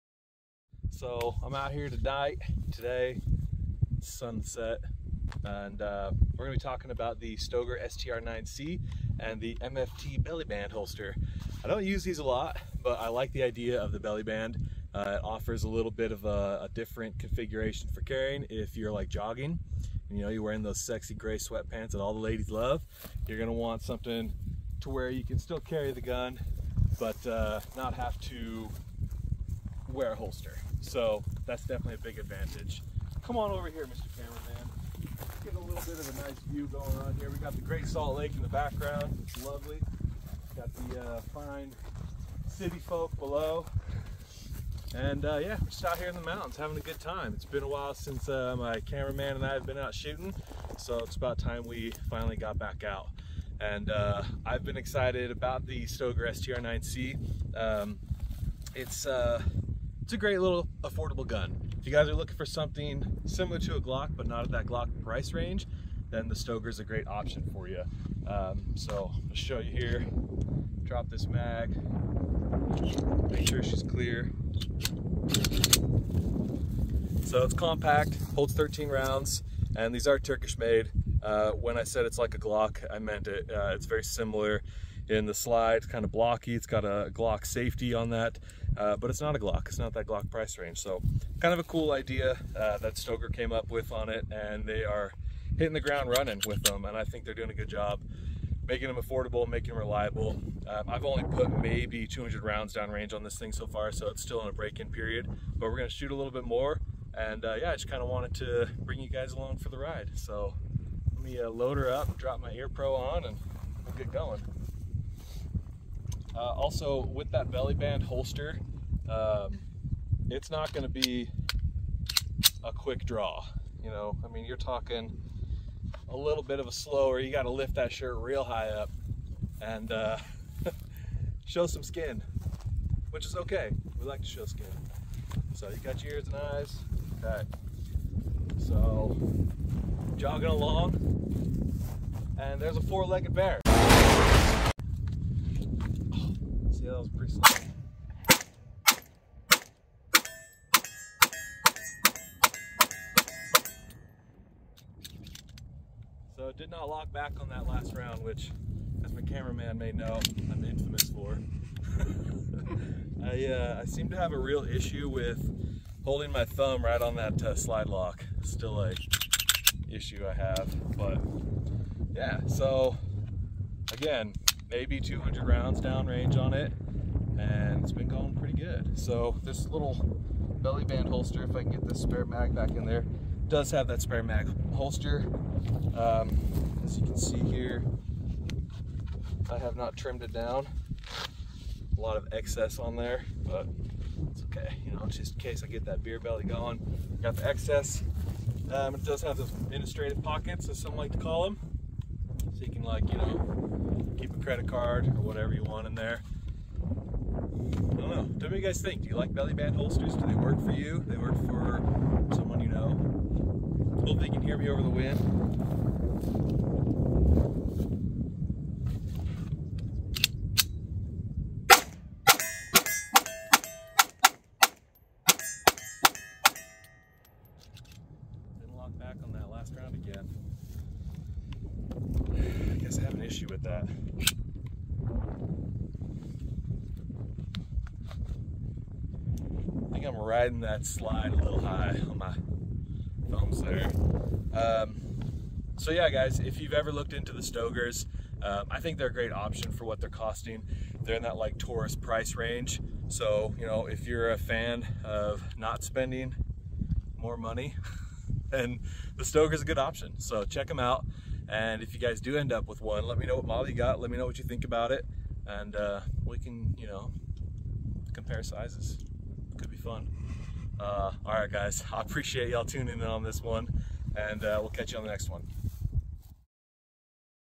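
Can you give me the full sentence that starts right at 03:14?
You know, just in case I get that beer belly going.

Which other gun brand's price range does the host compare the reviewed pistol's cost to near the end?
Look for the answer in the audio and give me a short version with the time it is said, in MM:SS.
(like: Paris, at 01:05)
Taurus, at 04:11.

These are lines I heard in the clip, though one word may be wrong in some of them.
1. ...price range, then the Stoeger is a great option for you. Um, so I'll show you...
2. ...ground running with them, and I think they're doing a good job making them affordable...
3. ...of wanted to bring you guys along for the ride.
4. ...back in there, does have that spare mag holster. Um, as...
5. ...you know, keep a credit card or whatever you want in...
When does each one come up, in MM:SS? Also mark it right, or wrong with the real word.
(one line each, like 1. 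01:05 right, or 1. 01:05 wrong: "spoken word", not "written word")
1. 01:05 right
2. 01:35 right
3. 01:48 right
4. 03:02 right
5. 03:23 right.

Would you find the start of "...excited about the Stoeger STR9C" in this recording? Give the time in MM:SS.
00:54.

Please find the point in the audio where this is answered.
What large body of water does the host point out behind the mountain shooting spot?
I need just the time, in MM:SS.
00:37.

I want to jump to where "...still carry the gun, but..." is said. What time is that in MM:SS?
00:25.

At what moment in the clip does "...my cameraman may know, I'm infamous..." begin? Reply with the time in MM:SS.
02:39.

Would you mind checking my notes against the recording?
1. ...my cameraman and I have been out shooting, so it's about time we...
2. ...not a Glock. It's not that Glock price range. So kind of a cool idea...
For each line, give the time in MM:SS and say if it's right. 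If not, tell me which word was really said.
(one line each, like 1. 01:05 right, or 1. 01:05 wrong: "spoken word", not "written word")
1. 00:48 right
2. 01:29 right.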